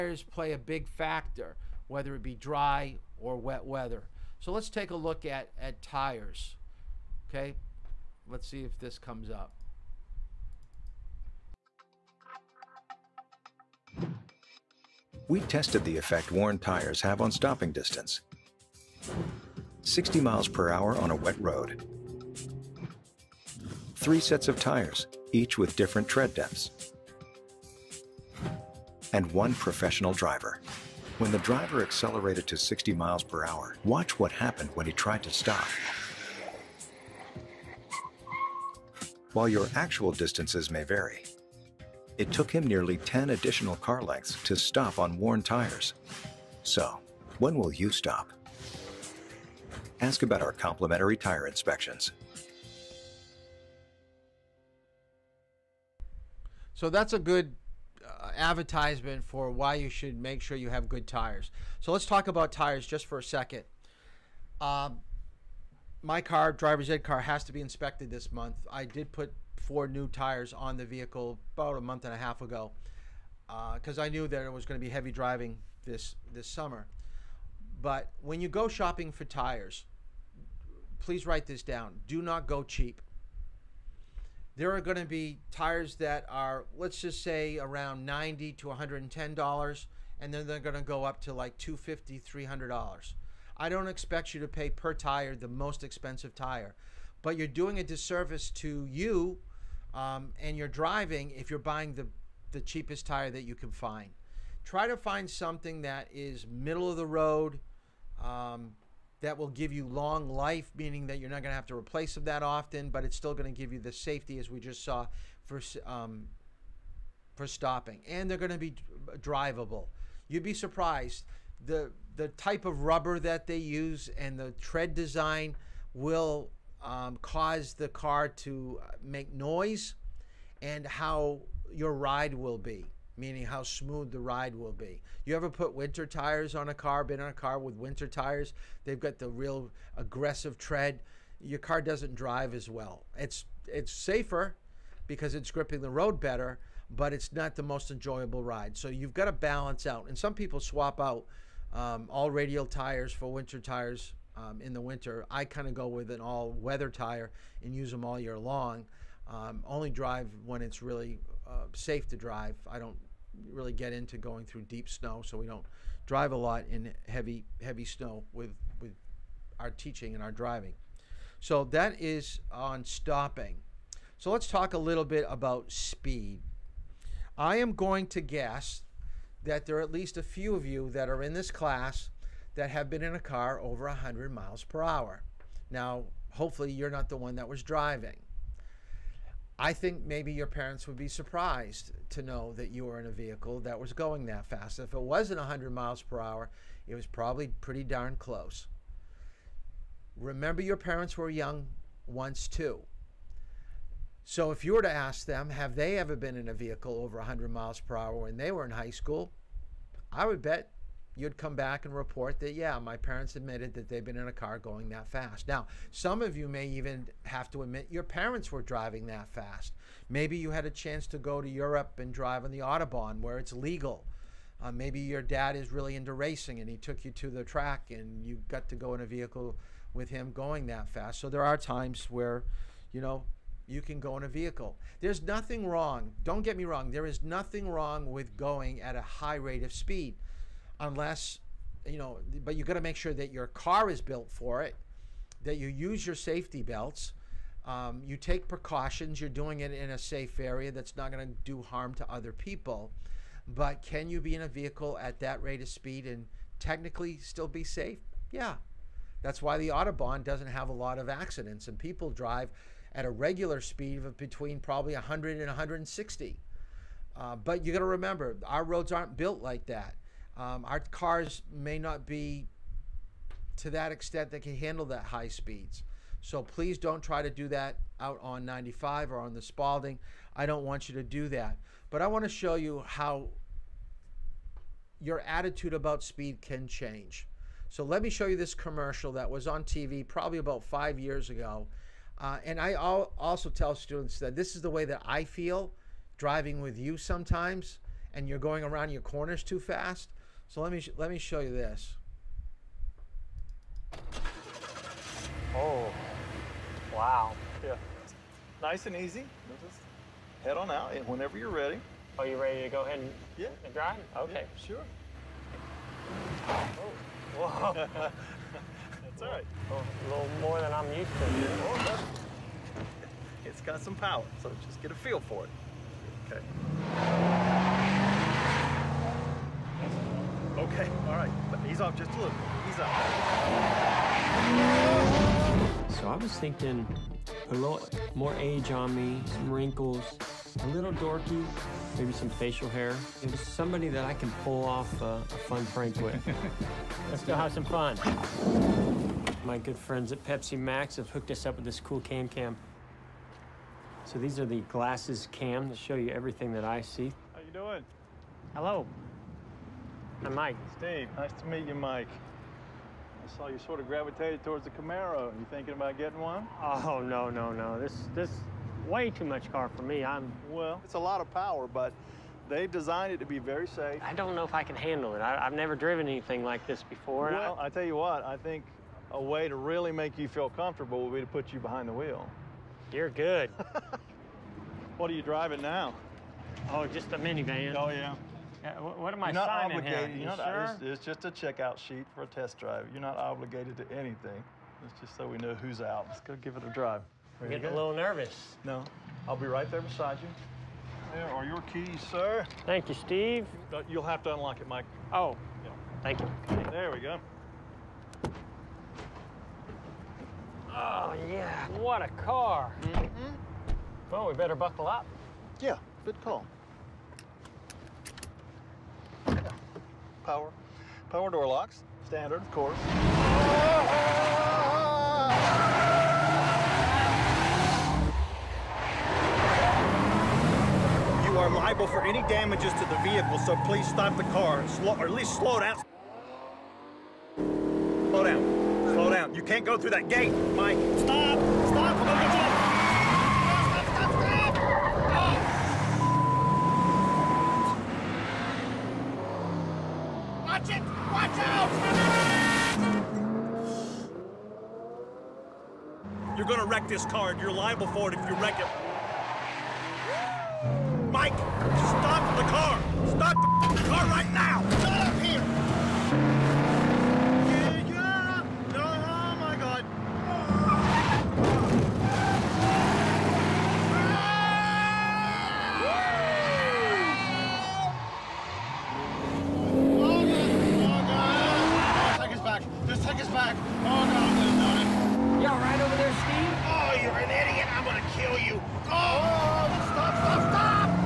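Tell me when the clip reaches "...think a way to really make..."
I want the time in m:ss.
6:18.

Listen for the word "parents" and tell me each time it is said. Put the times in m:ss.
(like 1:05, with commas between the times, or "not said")
3:10, 3:20, 3:32, 3:38.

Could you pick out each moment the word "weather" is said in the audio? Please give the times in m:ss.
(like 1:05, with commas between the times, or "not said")
0:03, 2:36.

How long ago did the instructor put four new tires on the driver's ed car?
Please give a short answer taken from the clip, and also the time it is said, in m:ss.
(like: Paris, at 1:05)
About a month and a half, at 1:11.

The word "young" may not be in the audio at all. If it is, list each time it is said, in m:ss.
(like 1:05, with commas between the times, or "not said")
3:21.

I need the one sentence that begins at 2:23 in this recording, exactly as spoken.
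It's it's safer because it's gripping the road better, but it's not the most enjoyable ride.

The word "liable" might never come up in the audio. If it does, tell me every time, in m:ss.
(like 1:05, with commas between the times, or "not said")
7:11, 7:37.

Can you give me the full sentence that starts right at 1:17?
But when you go shopping for tires, please write this down.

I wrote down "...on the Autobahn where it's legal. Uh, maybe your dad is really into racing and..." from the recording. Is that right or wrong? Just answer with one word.
right.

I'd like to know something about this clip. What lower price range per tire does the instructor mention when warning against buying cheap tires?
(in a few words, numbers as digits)
$90 to $110.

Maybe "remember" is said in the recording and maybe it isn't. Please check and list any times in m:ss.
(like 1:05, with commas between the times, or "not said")
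3:20, 4:27.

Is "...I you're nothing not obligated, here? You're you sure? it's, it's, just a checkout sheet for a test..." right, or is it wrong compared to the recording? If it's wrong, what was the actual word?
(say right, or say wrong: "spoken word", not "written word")
wrong: "signing", not "nothing".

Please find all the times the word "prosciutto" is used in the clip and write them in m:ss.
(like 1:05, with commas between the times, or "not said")
not said.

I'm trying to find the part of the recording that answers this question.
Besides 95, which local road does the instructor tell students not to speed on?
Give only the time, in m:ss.
4:39.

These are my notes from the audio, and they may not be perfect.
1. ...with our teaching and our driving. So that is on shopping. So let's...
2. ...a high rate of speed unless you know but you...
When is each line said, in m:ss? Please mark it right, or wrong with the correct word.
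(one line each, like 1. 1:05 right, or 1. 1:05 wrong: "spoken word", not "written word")
1. 2:48 wrong: "stopping", not "shopping"
2. 3:58 right.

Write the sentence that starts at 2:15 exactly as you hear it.
You ever put winter tires on a car, been on a car with winter tires?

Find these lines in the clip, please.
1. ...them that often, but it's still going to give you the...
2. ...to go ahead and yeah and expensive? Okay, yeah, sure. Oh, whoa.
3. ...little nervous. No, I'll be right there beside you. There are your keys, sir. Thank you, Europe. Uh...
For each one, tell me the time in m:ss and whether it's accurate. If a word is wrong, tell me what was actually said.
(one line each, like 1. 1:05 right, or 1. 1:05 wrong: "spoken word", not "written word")
1. 1:52 right
2. 5:12 wrong: "drive", not "expensive"
3. 6:37 wrong: "Steve", not "Europe".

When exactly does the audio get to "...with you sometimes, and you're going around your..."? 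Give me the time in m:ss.
4:56.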